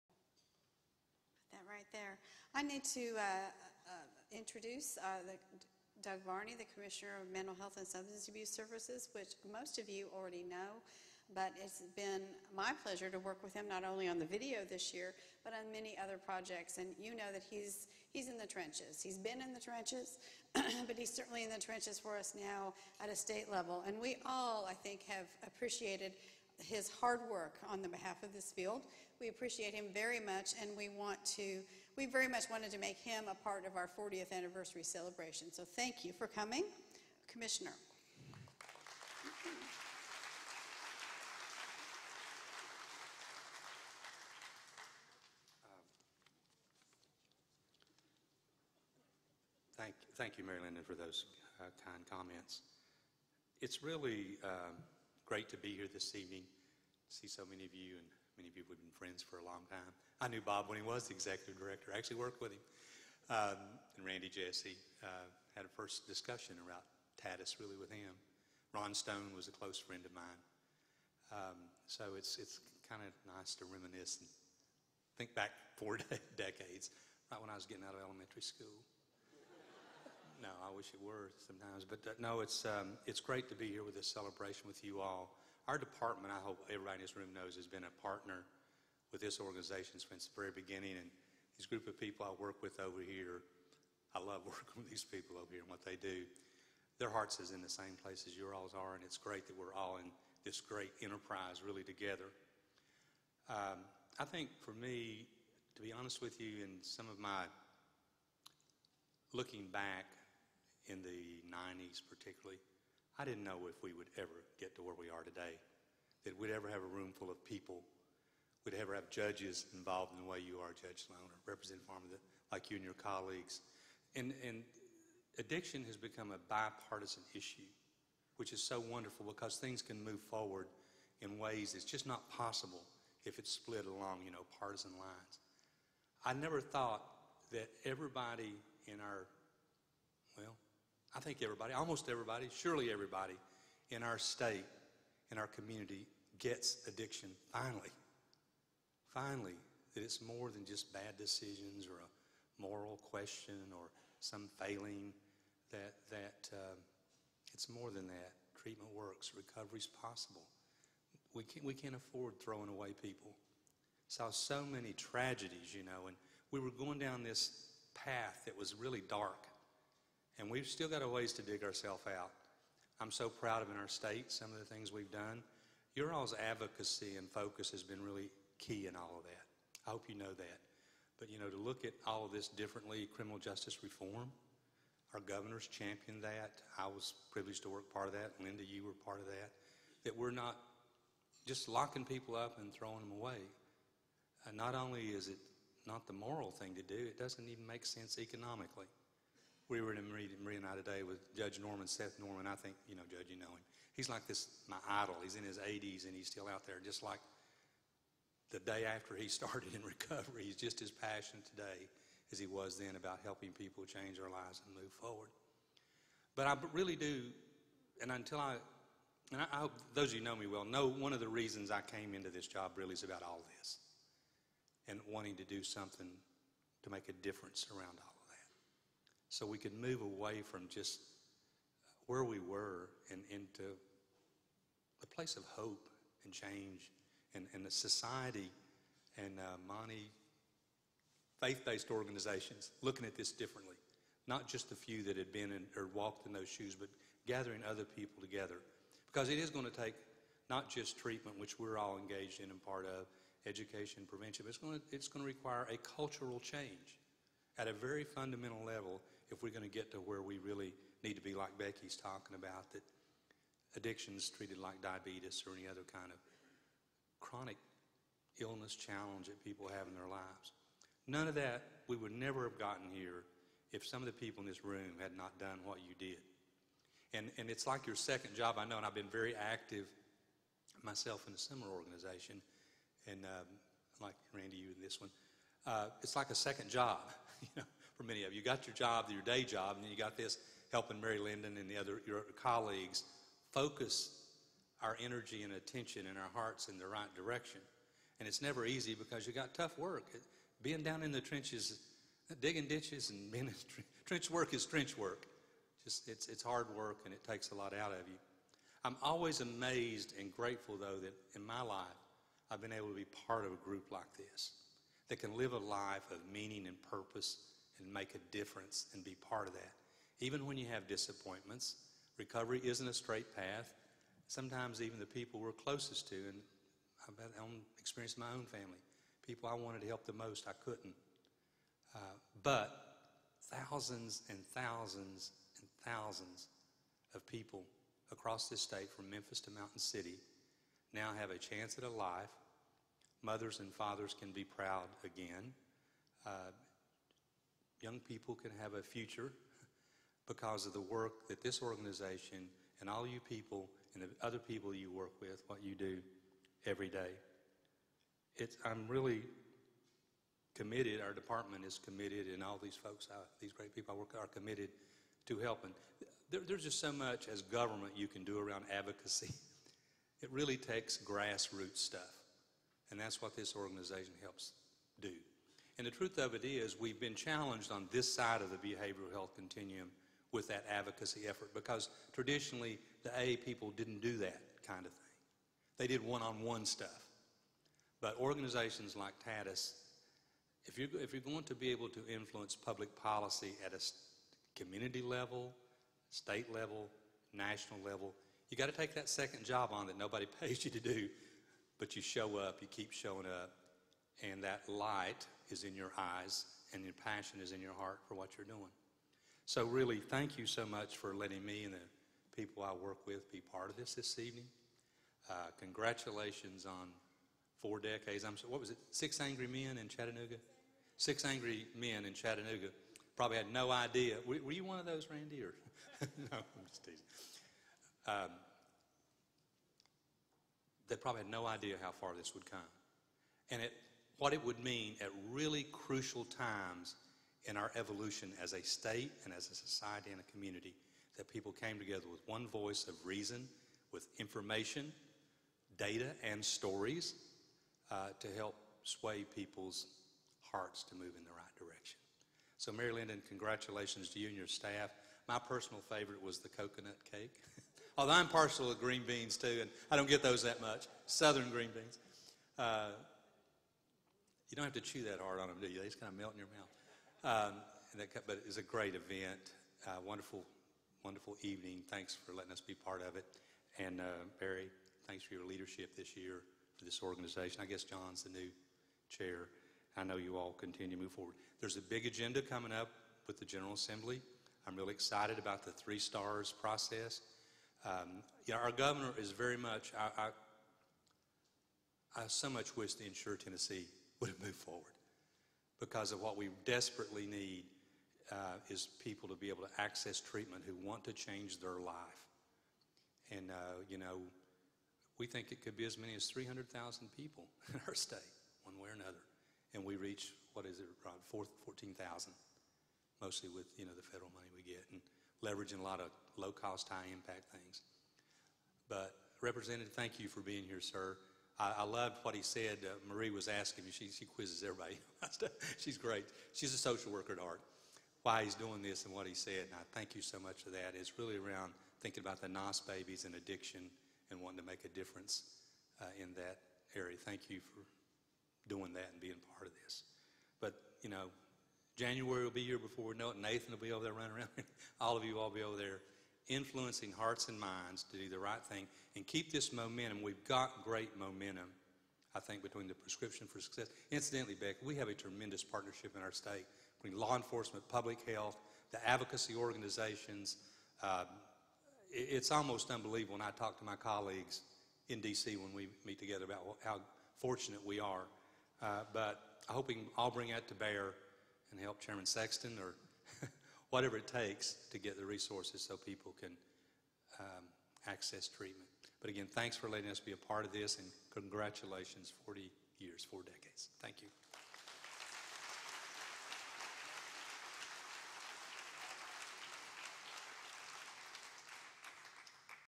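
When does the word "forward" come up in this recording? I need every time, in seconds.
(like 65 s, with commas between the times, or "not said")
130 s, 214 s, 481 s, 494 s.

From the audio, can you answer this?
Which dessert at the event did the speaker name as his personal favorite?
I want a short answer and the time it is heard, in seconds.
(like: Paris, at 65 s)
coconut cake, at 456 s.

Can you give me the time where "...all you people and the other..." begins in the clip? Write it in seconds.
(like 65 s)
352 s.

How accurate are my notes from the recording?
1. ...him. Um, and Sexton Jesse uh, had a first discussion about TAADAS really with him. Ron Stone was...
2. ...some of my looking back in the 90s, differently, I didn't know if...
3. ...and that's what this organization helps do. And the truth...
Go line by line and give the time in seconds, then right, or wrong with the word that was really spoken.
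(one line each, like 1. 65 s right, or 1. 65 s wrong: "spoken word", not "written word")
1. 62 s wrong: "Randy", not "Sexton"
2. 106 s wrong: "particularly", not "differently"
3. 372 s right.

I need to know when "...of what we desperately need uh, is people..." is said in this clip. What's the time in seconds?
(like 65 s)
496 s.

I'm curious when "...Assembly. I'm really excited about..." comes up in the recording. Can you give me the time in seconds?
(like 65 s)
483 s.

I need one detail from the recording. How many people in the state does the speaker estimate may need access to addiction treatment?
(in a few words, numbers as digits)
300,000.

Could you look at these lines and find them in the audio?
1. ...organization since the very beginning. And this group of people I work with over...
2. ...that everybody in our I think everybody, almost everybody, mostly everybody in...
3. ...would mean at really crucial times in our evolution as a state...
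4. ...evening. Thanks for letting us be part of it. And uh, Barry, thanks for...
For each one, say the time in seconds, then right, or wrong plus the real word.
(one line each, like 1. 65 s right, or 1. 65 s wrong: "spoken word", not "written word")
1. 89 s right
2. 137 s wrong: "surely", not "mostly"
3. 434 s right
4. 471 s right.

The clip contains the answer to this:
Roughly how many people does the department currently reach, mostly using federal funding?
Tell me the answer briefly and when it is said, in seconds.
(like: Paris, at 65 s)
14,000, at 511 s.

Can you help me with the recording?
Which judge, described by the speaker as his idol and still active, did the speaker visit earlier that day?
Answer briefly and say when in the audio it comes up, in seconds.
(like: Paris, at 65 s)
Seth Norman, at 201 s.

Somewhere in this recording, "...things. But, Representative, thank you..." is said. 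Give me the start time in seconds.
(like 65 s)
517 s.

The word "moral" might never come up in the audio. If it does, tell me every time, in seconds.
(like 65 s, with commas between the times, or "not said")
152 s, 196 s.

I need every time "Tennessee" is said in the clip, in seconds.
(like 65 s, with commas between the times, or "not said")
493 s.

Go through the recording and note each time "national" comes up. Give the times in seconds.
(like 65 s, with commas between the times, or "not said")
397 s.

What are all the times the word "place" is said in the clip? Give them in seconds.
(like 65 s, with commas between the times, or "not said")
98 s, 235 s.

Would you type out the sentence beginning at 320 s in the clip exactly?
Even when you have disappointments, recovery isn't a straight path.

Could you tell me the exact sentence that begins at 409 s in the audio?
So, really, thank you so much for letting me and the people I work with be part of this this evening.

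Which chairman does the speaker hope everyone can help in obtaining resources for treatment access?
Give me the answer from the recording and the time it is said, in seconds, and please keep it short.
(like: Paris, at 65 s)
Chairman Sexton, at 572 s.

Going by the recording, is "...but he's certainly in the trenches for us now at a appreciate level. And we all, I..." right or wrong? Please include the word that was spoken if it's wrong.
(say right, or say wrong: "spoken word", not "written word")
wrong: "state", not "appreciate".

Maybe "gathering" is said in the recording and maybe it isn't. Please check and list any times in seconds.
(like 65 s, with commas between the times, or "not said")
247 s.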